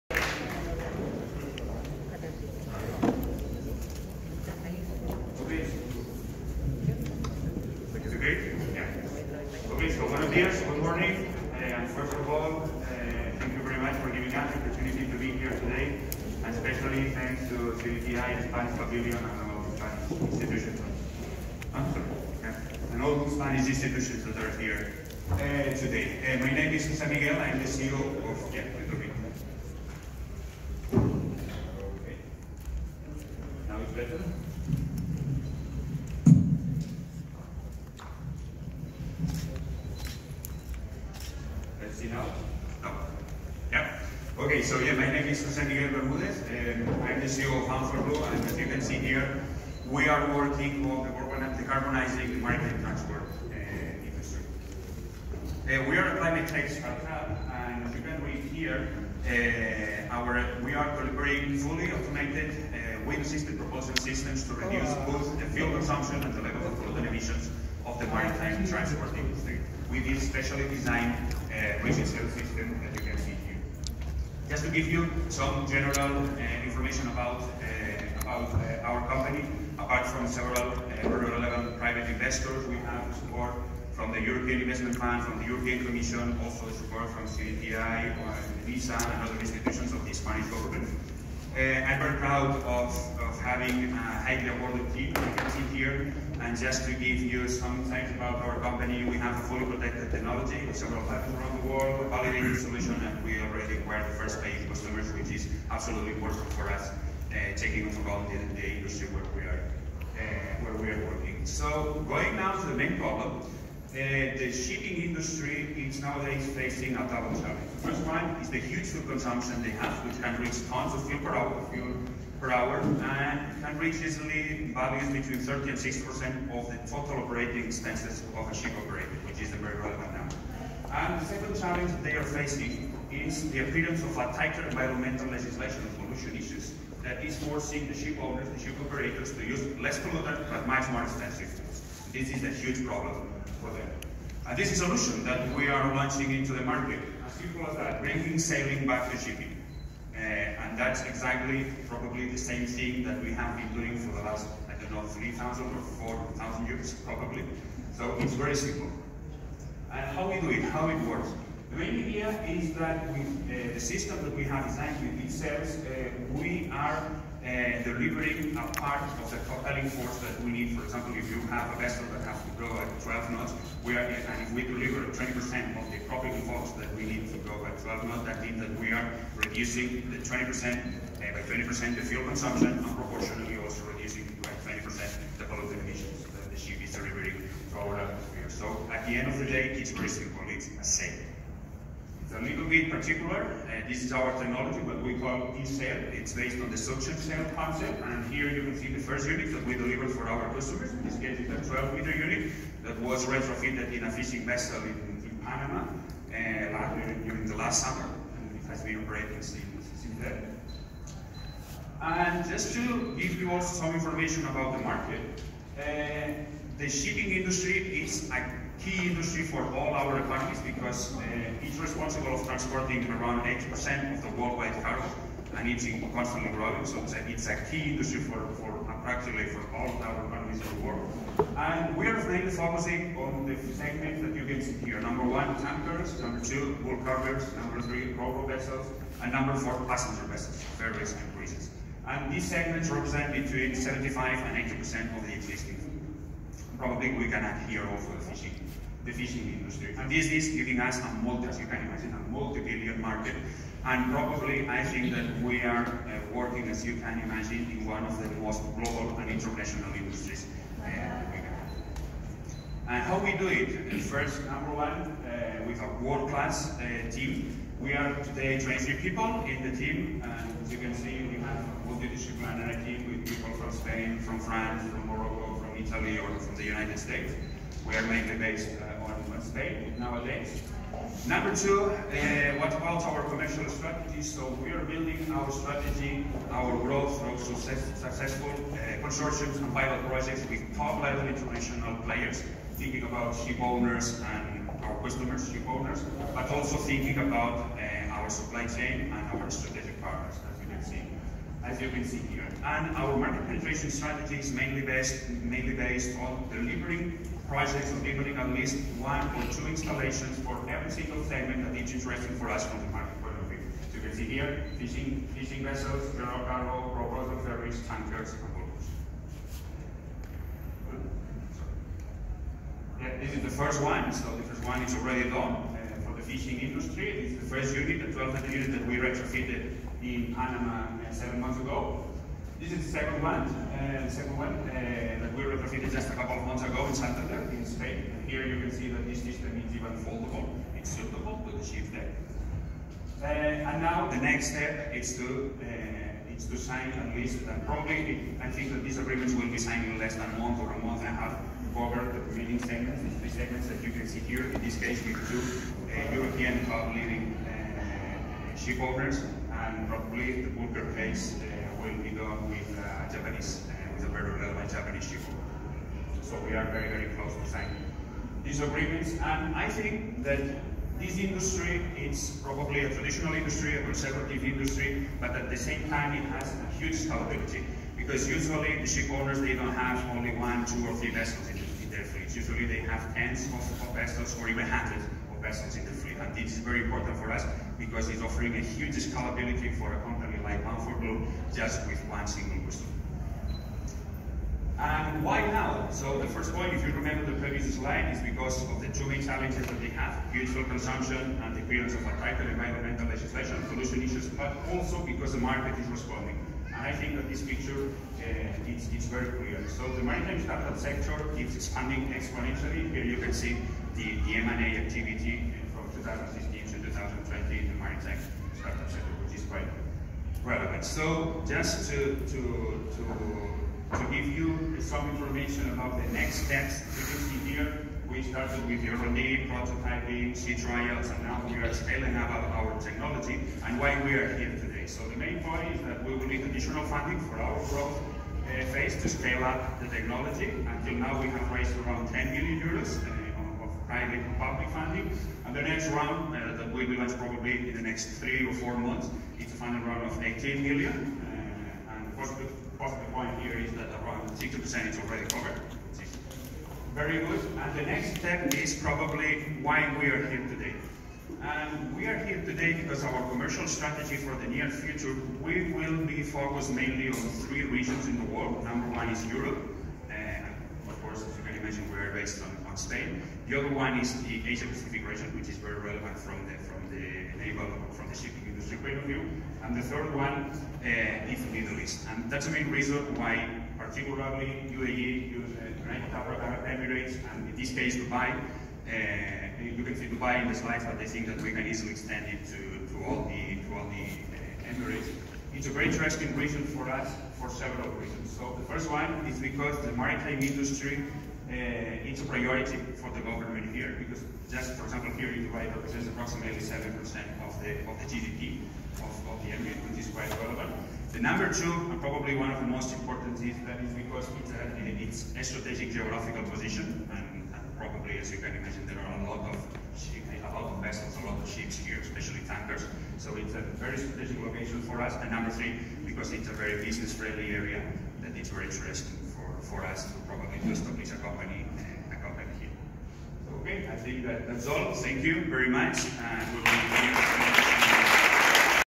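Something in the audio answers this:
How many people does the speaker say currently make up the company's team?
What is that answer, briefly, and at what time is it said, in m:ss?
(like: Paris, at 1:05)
23, at 4:28.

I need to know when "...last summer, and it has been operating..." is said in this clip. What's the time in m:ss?
3:27.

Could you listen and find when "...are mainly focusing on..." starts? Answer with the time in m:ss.
3:52.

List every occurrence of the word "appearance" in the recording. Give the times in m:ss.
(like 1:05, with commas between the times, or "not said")
2:13, 6:41.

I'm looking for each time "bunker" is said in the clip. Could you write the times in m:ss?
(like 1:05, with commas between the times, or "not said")
6:00.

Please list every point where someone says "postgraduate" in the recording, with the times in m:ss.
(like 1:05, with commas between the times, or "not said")
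not said.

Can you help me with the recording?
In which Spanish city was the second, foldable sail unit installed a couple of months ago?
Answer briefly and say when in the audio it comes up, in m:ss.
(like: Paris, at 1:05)
Santander, at 5:36.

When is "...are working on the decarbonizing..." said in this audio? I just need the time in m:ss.
0:50.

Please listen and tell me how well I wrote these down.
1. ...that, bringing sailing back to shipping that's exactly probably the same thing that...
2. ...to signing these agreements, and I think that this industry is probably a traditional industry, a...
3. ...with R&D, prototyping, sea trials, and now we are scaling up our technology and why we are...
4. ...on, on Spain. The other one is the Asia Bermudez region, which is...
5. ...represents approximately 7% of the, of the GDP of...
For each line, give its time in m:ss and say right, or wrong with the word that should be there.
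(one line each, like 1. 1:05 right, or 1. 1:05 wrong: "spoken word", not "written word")
1. 2:27 right
2. 6:07 right
3. 7:08 right
4. 7:52 wrong: "Pacific", not "Bermudez"
5. 8:25 right.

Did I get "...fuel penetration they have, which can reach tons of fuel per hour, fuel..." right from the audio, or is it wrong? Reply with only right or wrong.
wrong.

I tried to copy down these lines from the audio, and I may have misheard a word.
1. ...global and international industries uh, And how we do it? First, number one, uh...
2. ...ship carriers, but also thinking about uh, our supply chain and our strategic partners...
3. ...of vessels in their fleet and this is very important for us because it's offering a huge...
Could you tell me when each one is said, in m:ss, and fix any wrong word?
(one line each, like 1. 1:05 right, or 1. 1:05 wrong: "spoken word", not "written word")
1. 4:18 right
2. 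4:55 wrong: "owners", not "carriers"
3. 6:25 right.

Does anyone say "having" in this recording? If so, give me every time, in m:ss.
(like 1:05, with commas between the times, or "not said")
1:33.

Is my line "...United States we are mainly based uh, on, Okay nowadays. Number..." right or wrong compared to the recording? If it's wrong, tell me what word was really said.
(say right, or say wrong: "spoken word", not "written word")
wrong: "Spain", not "Okay".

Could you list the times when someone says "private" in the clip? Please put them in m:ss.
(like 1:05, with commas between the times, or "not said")
1:21, 7:23.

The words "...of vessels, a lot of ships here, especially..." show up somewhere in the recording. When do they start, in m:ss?
8:40.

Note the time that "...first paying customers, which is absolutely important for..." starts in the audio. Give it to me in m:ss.
1:44.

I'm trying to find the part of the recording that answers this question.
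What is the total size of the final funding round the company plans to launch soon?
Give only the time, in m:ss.
7:30.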